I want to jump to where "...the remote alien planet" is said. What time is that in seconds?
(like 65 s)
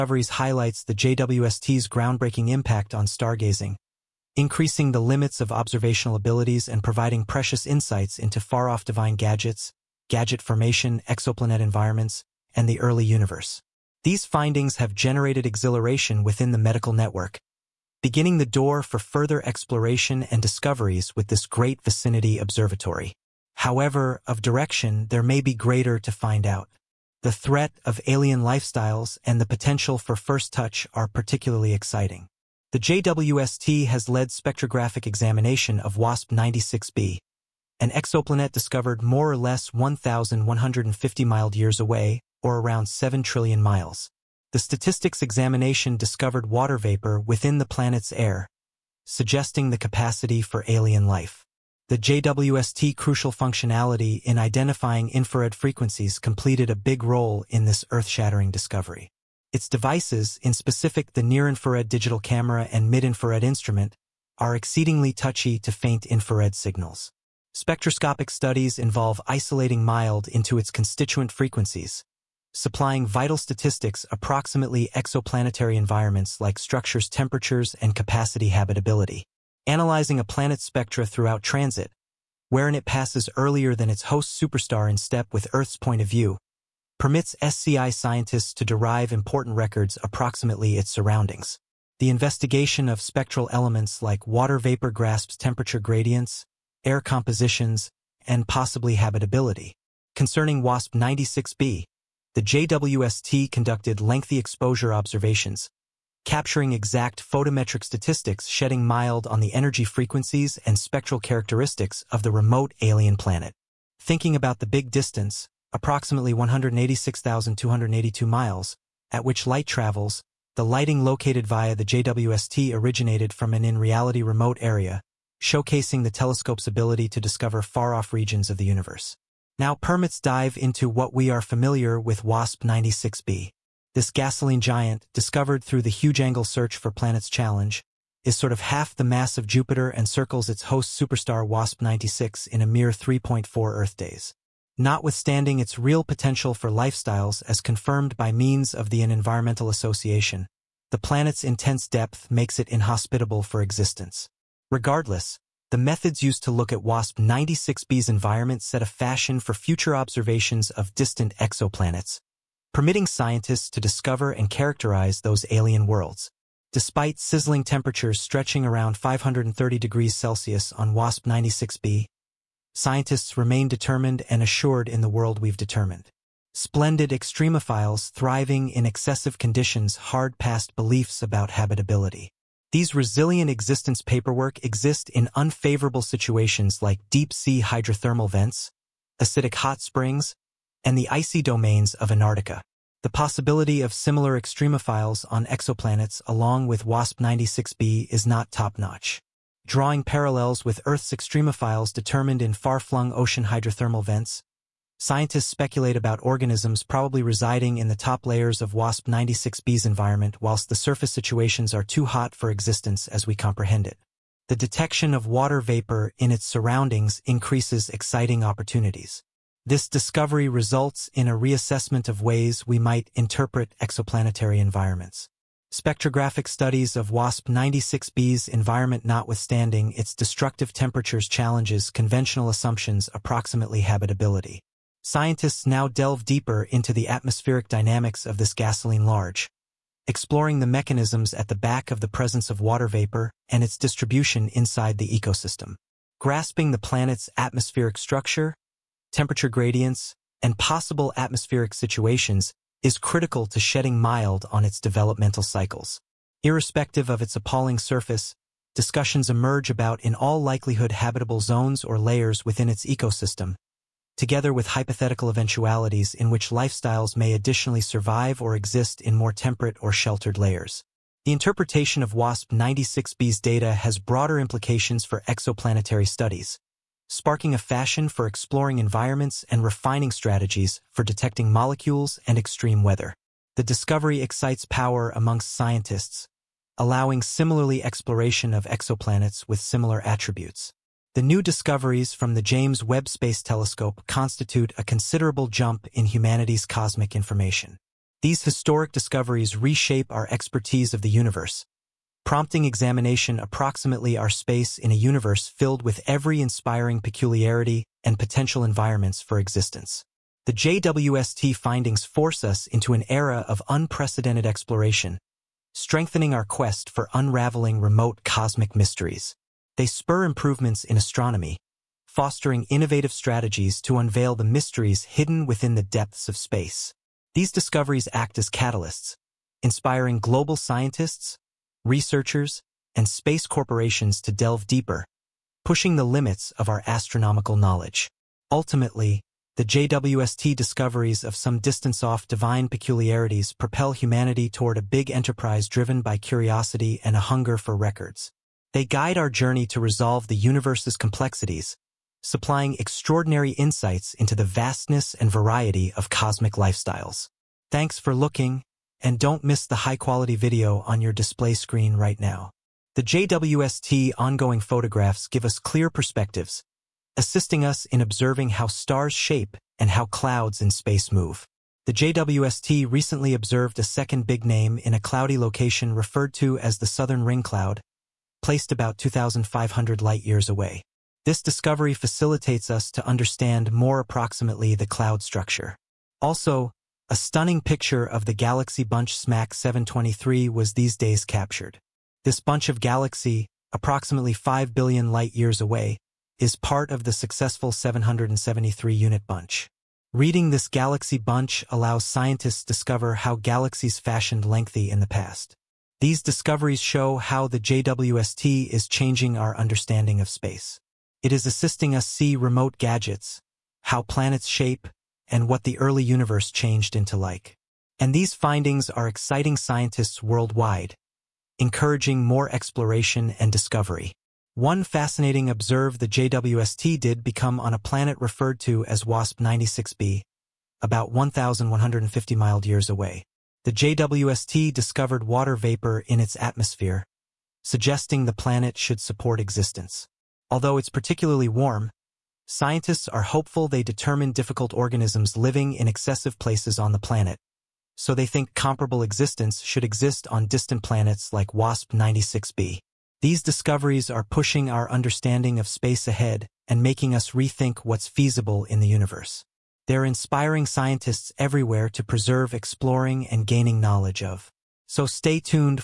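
112 s.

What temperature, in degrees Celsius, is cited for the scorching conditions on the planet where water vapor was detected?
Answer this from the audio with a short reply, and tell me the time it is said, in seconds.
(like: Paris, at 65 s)
530 degrees Celsius, at 168 s.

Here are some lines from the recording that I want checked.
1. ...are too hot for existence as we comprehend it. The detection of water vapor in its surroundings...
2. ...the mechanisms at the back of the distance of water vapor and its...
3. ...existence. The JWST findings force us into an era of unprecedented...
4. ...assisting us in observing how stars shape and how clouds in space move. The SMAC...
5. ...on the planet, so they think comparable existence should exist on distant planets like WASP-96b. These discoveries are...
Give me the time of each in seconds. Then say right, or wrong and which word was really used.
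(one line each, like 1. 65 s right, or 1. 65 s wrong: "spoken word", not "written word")
1. 211 s right
2. 240 s wrong: "presence", not "distance"
3. 309 s right
4. 367 s wrong: "JWST", not "SMAC"
5. 446 s right.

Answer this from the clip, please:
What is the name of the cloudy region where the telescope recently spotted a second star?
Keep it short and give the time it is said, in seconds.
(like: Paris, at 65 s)
Southern Ring Cloud, at 376 s.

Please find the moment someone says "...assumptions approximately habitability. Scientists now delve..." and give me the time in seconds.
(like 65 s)
232 s.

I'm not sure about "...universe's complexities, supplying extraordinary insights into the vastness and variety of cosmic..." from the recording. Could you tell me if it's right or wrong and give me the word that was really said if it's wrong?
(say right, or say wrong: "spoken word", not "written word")
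right.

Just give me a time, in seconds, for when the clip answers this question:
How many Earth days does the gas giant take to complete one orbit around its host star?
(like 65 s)
142 s.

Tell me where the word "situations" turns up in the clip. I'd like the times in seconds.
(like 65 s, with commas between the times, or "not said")
186 s, 211 s, 251 s.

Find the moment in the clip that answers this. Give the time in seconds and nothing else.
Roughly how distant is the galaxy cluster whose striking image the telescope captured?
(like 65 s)
394 s.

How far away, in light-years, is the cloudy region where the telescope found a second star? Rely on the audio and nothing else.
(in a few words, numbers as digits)
2,500.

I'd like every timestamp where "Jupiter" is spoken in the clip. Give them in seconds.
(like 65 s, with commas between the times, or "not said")
139 s.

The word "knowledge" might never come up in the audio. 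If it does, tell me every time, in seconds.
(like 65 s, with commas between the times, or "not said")
337 s, 463 s.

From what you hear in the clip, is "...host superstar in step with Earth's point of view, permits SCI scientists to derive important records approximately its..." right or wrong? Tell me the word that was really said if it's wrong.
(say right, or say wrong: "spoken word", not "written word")
right.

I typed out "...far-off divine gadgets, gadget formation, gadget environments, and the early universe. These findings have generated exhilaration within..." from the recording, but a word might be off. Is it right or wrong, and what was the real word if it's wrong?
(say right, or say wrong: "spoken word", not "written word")
wrong: "exoplanet", not "gadget".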